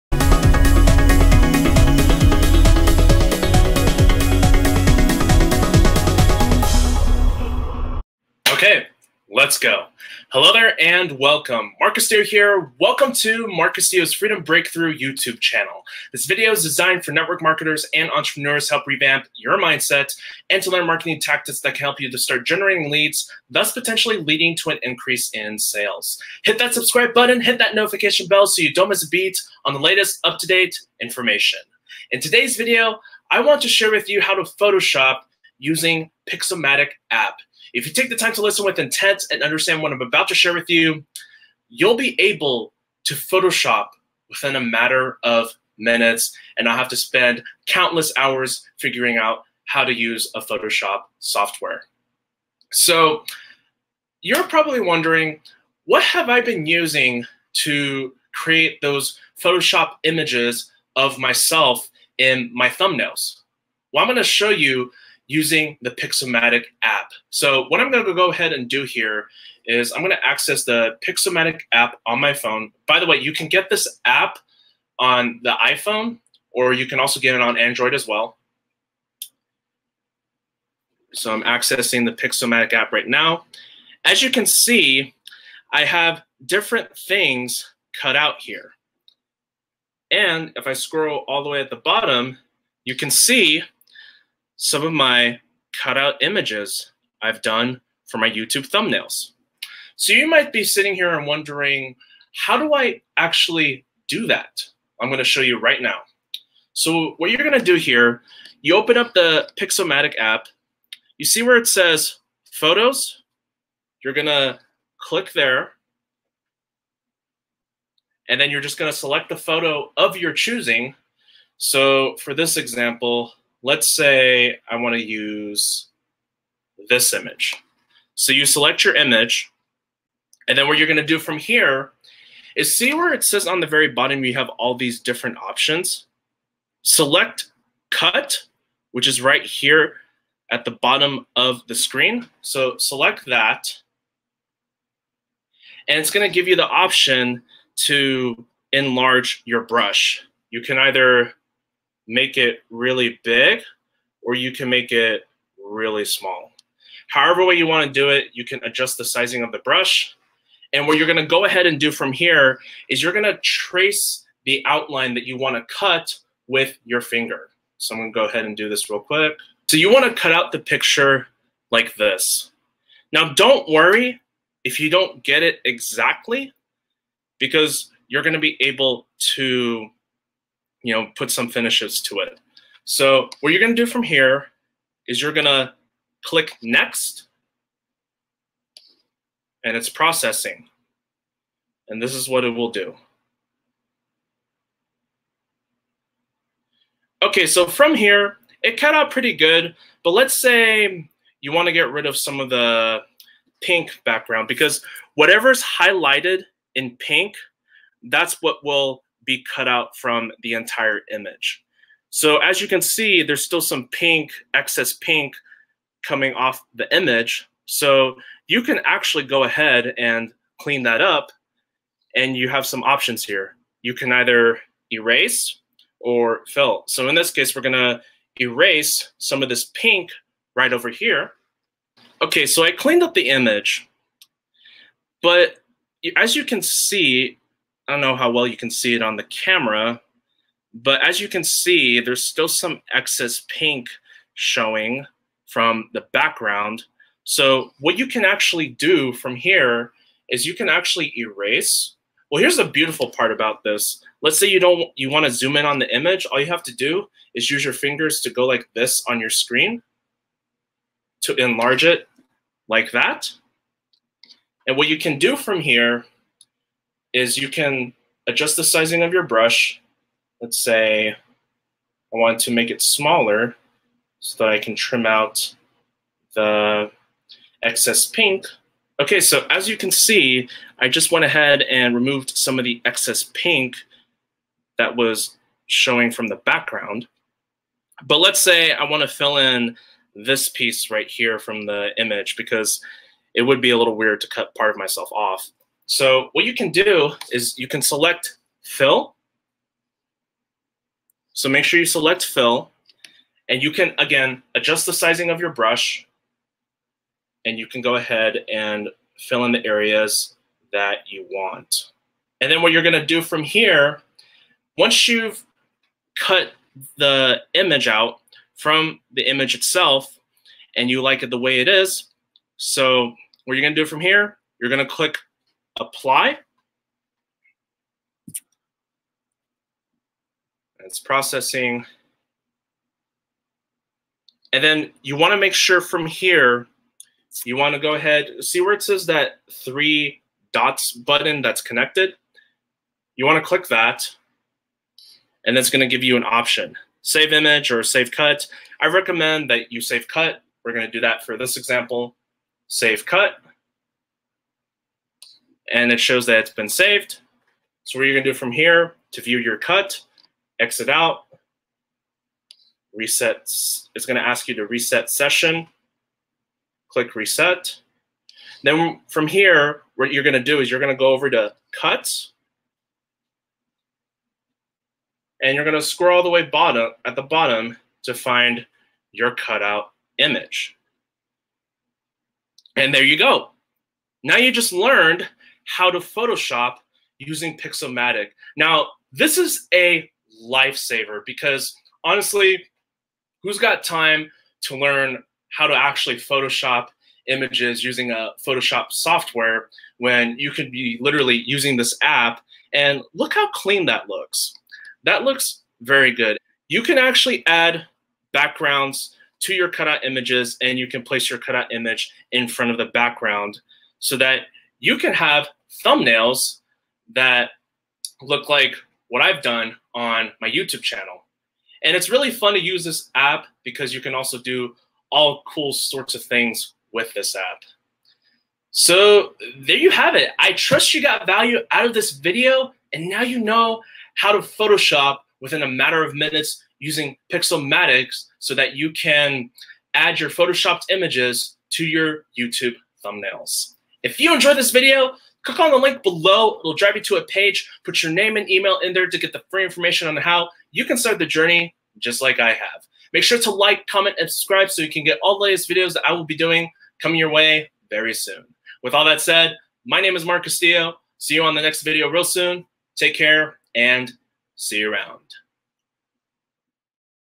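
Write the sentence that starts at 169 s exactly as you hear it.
So you want to cut out the picture like this.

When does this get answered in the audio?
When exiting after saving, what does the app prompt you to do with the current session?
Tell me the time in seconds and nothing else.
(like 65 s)
364 s.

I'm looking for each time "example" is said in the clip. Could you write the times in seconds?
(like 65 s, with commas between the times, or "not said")
122 s, 351 s.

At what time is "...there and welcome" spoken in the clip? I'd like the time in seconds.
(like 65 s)
10 s.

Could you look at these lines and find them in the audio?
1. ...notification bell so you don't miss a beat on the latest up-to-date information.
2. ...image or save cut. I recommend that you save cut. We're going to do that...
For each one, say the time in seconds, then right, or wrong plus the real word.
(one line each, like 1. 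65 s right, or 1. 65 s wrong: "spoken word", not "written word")
1. 27 s right
2. 347 s right.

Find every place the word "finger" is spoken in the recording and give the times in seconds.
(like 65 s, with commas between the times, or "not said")
167 s, 257 s.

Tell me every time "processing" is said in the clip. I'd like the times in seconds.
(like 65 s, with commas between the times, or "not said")
189 s, 330 s.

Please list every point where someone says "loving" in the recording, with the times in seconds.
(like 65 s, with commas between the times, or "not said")
not said.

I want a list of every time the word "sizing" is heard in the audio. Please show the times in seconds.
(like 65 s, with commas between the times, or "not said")
159 s, 268 s, 304 s.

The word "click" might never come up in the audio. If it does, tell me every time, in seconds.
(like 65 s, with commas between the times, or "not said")
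115 s, 186 s, 324 s, 343 s, 366 s, 445 s.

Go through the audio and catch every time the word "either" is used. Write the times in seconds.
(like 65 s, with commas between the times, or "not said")
150 s, 224 s.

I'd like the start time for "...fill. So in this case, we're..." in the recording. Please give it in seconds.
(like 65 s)
226 s.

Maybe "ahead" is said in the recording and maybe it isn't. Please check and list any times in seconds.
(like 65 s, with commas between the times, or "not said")
68 s, 161 s, 168 s, 219 s, 281 s, 307 s, 337 s.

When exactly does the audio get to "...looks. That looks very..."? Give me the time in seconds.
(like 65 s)
404 s.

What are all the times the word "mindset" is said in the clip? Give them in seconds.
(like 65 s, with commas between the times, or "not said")
19 s.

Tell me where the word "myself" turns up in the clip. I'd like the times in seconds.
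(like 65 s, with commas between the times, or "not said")
61 s, 294 s.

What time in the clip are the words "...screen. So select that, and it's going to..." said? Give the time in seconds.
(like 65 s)
141 s.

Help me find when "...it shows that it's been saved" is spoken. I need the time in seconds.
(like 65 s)
355 s.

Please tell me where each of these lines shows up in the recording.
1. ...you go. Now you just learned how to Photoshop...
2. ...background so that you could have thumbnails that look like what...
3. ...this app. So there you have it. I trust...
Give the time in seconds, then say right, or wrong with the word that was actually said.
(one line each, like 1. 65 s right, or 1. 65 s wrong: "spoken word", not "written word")
1. 383 s right
2. 412 s right
3. 427 s right.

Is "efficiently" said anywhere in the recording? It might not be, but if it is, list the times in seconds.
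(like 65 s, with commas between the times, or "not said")
not said.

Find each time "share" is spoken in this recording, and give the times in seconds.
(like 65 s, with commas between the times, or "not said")
33 s, 40 s.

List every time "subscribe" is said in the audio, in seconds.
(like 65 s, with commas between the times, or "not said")
26 s, 454 s.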